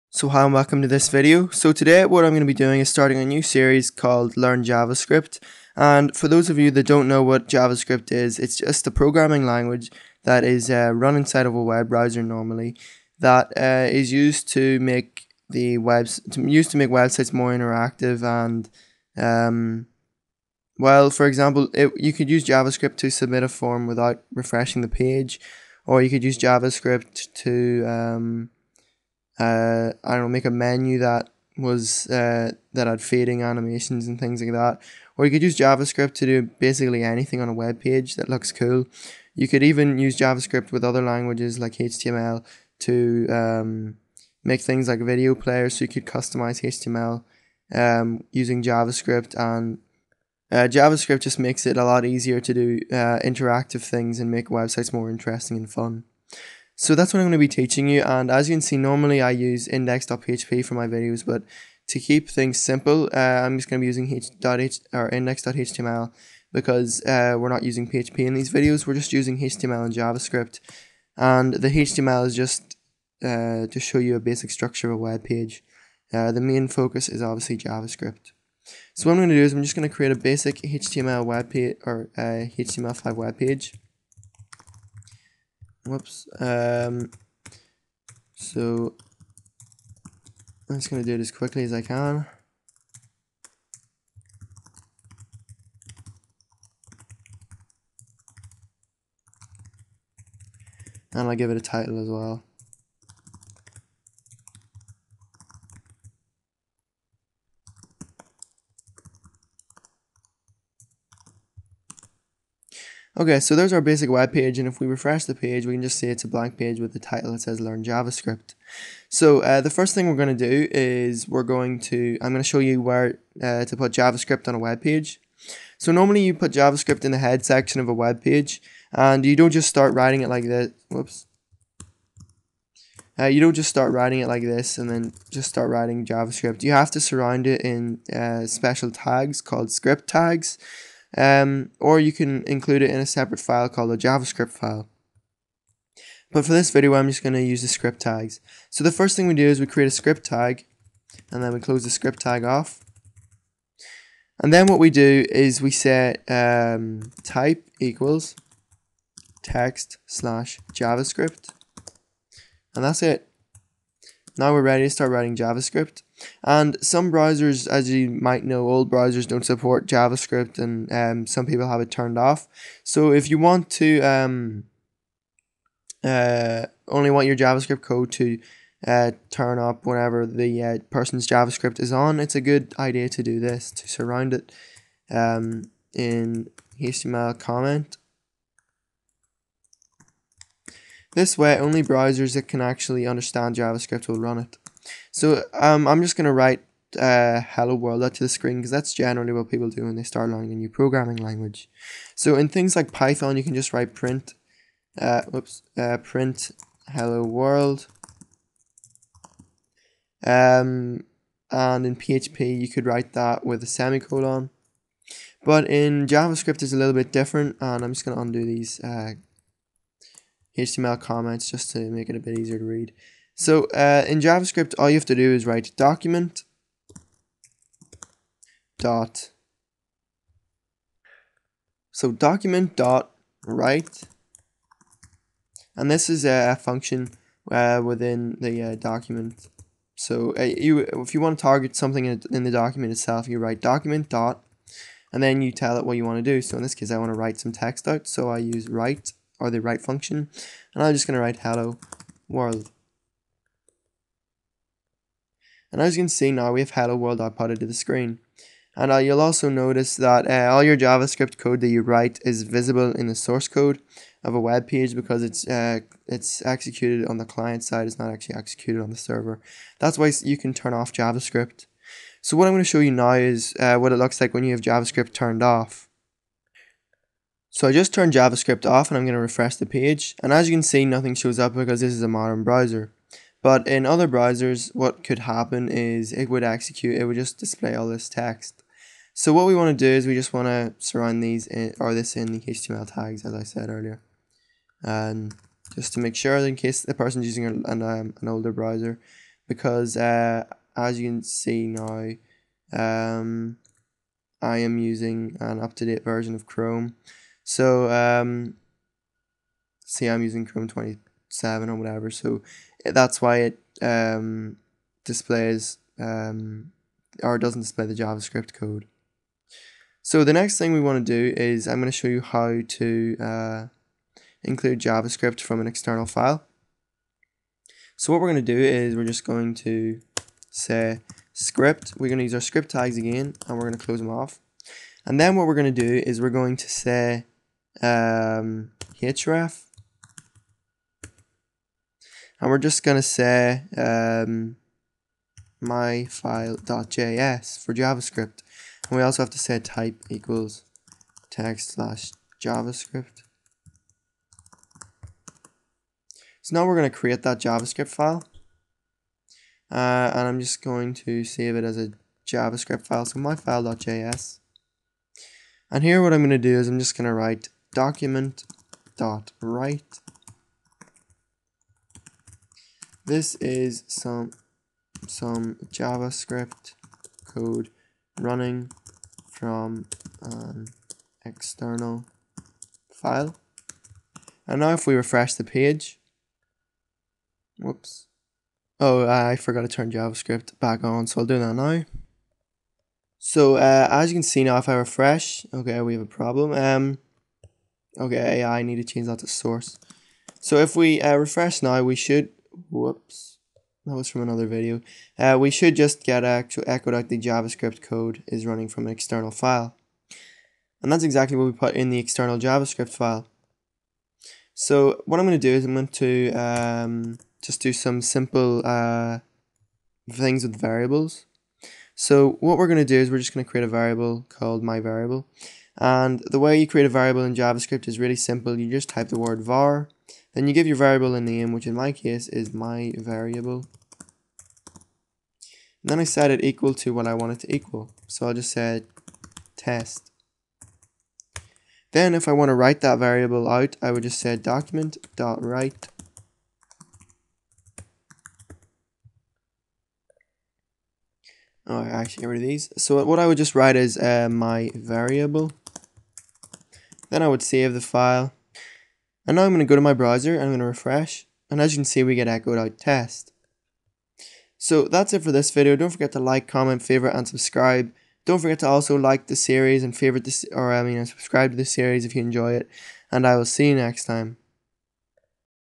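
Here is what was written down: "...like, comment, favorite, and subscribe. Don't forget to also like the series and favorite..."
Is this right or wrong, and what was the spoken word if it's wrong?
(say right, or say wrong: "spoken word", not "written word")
right.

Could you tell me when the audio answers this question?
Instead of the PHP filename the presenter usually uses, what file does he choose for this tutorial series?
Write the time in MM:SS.
01:05.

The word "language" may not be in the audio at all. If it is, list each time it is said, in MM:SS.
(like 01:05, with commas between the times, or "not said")
00:09, 00:41, 03:21.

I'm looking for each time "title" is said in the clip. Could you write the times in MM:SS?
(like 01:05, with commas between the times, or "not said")
01:41, 01:56.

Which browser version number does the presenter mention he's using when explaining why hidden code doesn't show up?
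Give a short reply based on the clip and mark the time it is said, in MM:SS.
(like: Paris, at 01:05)
27, at 05:10.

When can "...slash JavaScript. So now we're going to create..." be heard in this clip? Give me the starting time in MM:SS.
05:51.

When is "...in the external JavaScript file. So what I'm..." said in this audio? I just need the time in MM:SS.
06:51.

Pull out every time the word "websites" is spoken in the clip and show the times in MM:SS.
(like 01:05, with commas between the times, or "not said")
00:16, 00:54.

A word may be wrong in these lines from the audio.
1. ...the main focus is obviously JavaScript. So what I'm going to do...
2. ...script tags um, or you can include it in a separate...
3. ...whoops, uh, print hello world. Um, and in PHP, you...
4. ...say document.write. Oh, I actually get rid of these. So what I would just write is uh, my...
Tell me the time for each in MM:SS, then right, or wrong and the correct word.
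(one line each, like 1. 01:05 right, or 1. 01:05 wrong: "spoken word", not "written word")
1. 01:16 right
2. 02:19 right
3. 03:25 right
4. 07:24 right.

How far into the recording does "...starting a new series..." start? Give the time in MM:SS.
00:02.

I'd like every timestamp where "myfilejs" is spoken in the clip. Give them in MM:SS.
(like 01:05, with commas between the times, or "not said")
05:45, 06:03.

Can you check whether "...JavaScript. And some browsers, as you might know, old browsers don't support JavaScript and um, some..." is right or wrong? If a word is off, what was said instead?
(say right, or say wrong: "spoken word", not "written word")
right.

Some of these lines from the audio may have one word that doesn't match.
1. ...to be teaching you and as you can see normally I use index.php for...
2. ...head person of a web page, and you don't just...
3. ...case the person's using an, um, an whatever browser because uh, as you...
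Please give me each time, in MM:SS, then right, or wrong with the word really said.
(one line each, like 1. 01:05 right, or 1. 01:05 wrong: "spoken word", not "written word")
1. 00:57 right
2. 02:07 wrong: "section", not "person"
3. 04:56 wrong: "older", not "whatever".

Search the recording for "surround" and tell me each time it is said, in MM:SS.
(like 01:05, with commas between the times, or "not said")
02:17, 03:03, 04:50.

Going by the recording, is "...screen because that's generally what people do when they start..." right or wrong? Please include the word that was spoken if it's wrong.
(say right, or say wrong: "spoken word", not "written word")
right.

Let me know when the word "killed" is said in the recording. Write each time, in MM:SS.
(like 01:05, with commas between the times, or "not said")
not said.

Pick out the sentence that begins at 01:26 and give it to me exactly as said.
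Um, so I'm just going to do it as quickly as I can.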